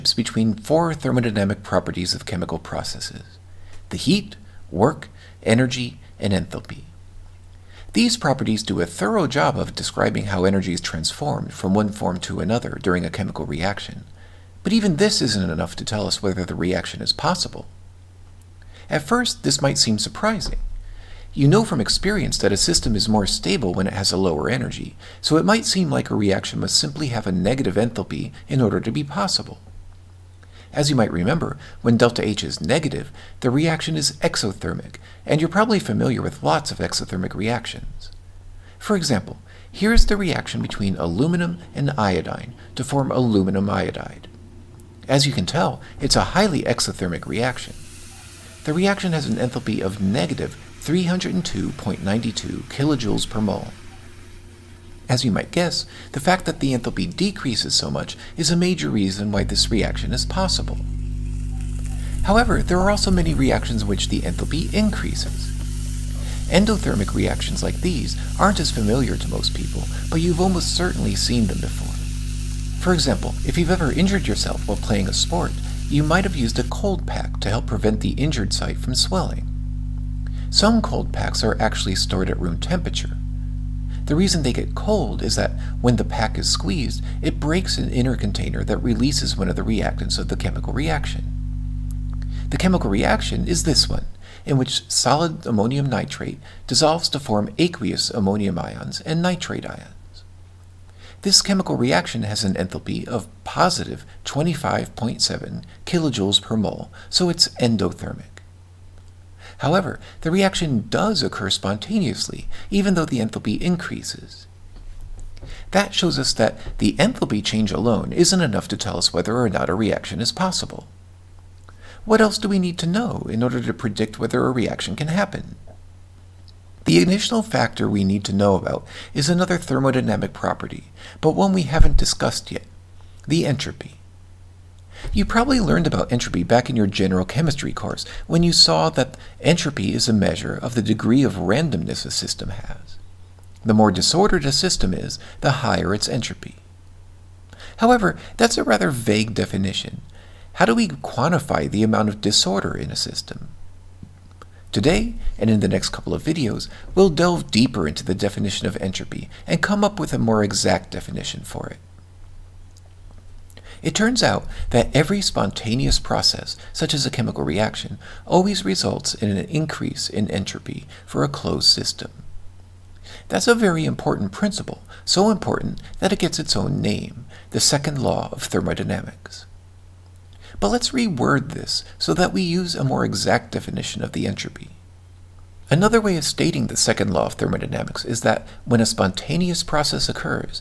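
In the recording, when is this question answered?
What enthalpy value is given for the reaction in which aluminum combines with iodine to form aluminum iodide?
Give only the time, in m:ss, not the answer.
0:50.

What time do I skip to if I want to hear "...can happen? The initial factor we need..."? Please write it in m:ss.
2:04.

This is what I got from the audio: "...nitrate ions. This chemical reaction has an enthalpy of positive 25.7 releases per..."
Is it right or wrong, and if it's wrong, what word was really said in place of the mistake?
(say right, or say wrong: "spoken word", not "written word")
wrong: "kilojoules", not "releases".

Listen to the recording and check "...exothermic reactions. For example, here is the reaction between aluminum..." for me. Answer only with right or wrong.
right.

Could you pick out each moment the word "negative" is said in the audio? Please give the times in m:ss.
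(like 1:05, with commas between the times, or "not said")
0:27, 0:32, 0:50.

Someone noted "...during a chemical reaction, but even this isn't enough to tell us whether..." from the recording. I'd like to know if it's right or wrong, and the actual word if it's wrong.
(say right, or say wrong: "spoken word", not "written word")
right.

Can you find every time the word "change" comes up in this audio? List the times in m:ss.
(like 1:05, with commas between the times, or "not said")
1:57.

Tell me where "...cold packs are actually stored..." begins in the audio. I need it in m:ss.
1:20.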